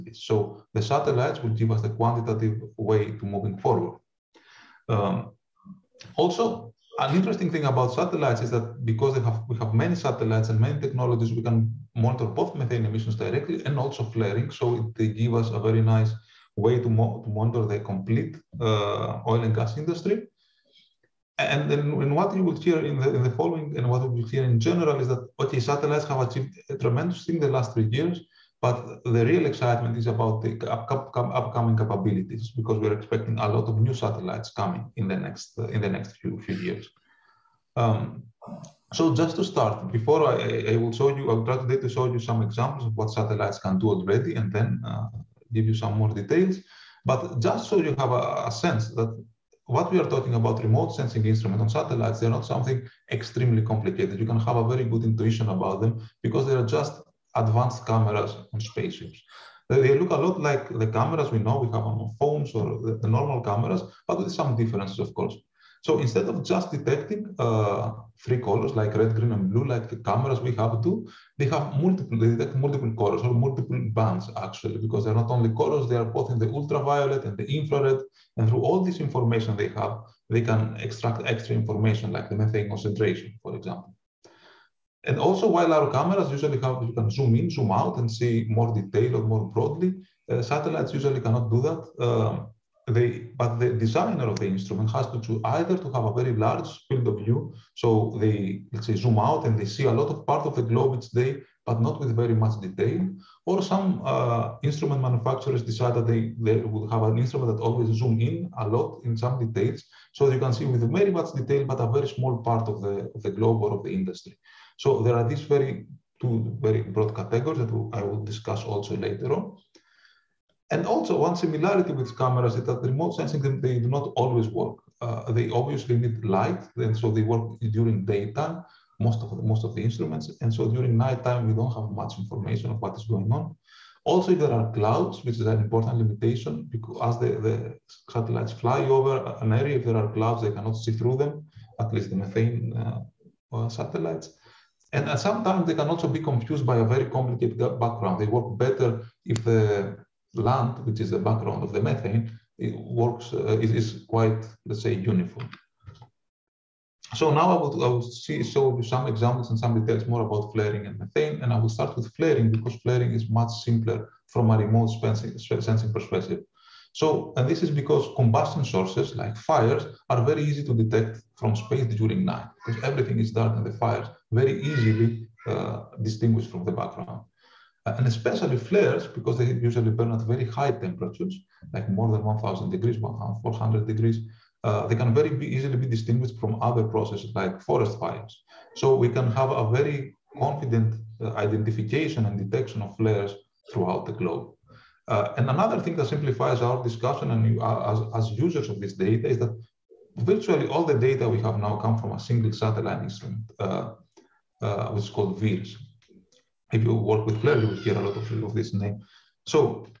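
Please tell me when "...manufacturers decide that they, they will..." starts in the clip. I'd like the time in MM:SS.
01:45.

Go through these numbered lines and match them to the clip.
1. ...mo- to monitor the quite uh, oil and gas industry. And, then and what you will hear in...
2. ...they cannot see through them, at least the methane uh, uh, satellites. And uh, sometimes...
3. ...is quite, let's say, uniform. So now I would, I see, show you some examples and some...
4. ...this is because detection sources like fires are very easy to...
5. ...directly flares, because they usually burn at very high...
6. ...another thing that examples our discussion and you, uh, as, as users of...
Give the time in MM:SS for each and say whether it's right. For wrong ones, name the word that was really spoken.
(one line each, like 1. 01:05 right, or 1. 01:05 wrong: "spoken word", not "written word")
1. 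00:16 wrong: "complete", not "quite"
2. 02:20 right
3. 02:33 right
4. 02:47 wrong: "combustion", not "detection"
5. 02:58 wrong: "especially", not "directly"
6. 03:15 wrong: "simplifies", not "examples".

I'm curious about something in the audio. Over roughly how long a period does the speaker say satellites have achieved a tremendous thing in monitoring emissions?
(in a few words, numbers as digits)
3 years.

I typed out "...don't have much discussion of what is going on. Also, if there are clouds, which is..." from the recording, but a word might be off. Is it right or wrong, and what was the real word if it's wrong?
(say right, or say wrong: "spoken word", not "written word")
wrong: "information", not "discussion".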